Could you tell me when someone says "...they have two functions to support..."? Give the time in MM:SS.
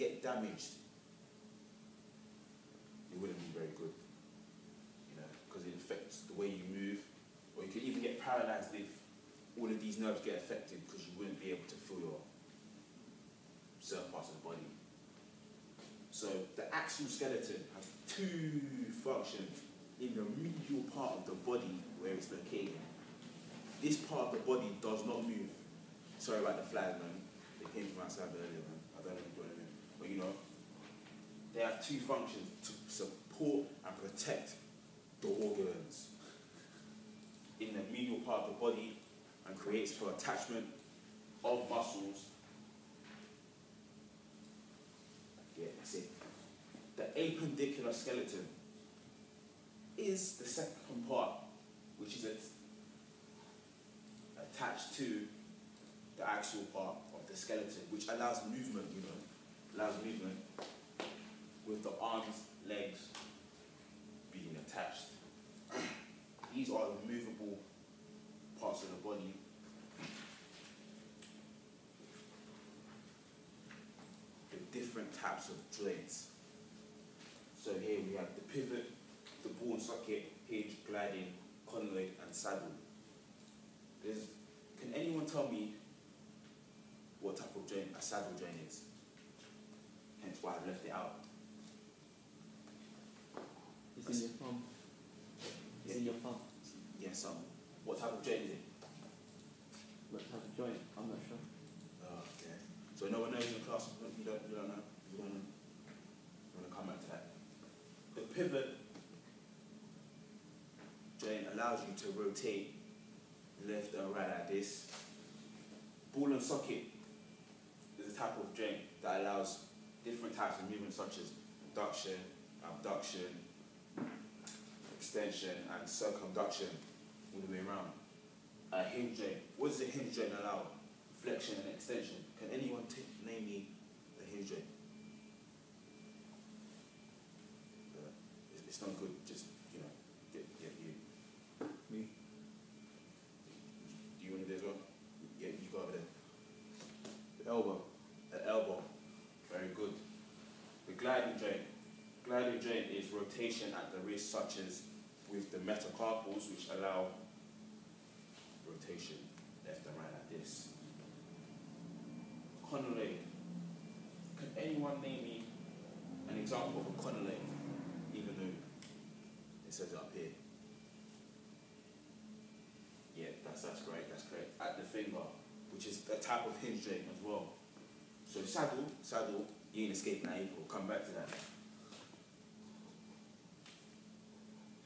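00:31.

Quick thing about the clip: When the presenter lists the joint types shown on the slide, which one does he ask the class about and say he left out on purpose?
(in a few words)
Saddle joint.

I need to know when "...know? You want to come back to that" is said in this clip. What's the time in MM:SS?
01:44.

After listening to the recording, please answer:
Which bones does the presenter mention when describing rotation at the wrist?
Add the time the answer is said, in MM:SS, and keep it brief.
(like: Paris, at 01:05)
Metacarpals, at 02:35.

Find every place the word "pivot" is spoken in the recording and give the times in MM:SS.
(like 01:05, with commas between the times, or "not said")
01:18, 01:48.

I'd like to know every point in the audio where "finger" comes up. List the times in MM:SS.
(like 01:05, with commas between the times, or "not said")
02:54.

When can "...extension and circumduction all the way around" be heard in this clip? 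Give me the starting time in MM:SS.
02:04.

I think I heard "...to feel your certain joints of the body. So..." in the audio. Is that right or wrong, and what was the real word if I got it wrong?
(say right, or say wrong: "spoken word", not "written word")
wrong: "parts", not "joints".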